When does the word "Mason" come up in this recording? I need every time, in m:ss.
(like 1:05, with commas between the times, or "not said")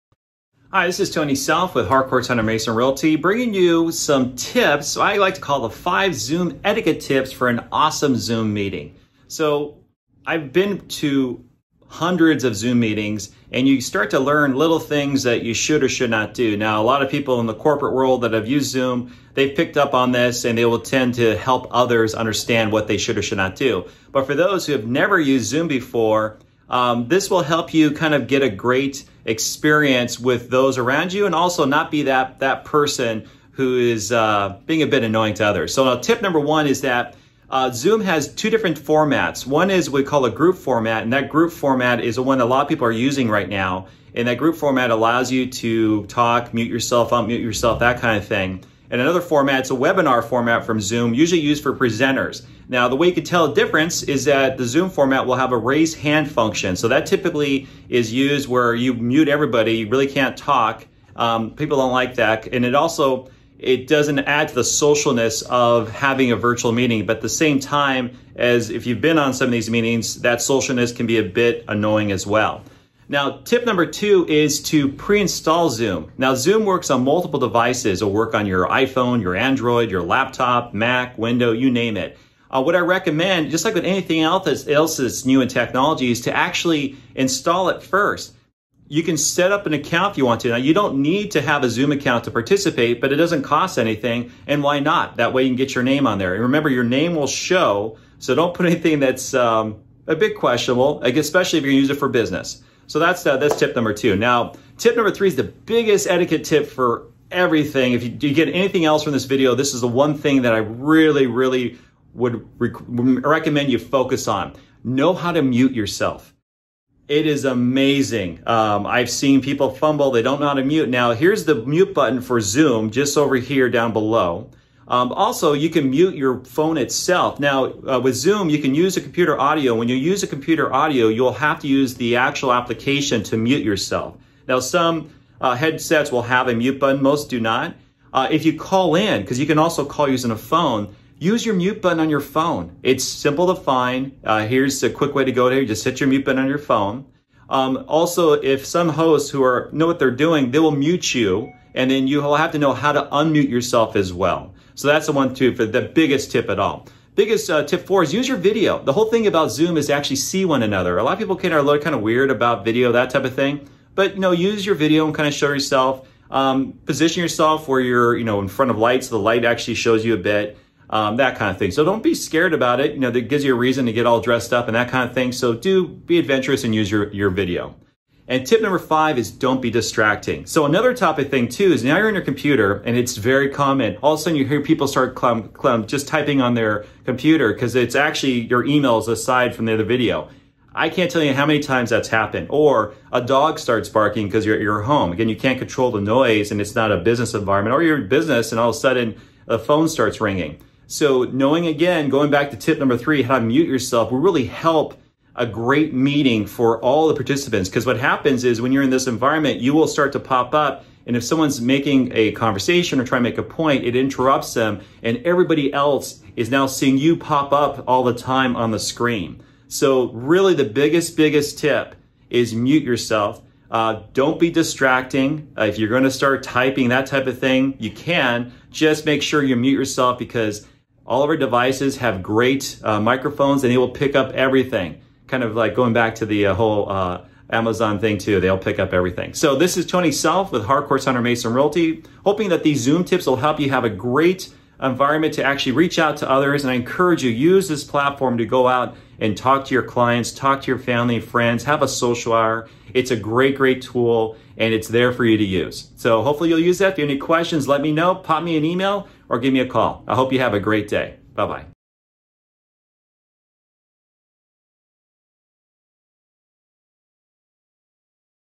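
0:02, 4:01.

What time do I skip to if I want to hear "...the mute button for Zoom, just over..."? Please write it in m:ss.
2:01.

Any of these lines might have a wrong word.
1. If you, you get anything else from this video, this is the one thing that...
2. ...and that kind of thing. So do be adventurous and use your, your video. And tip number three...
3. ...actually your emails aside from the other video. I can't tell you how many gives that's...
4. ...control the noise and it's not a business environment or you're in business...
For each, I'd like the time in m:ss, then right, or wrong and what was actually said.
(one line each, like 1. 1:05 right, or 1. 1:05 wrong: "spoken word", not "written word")
1. 1:47 right
2. 2:54 wrong: "five", not "three"
3. 3:07 wrong: "times", not "gives"
4. 3:15 right.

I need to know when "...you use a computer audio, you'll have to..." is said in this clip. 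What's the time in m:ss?
2:09.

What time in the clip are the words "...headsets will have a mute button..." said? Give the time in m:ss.
2:15.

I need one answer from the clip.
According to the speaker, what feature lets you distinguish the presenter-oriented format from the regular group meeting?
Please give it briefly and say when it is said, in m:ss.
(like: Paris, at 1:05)
raise hand function, at 0:55.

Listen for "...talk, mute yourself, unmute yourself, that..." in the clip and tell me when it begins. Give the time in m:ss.
0:46.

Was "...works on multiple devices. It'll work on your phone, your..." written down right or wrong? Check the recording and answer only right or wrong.
wrong.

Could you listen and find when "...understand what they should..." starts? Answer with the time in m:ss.
0:22.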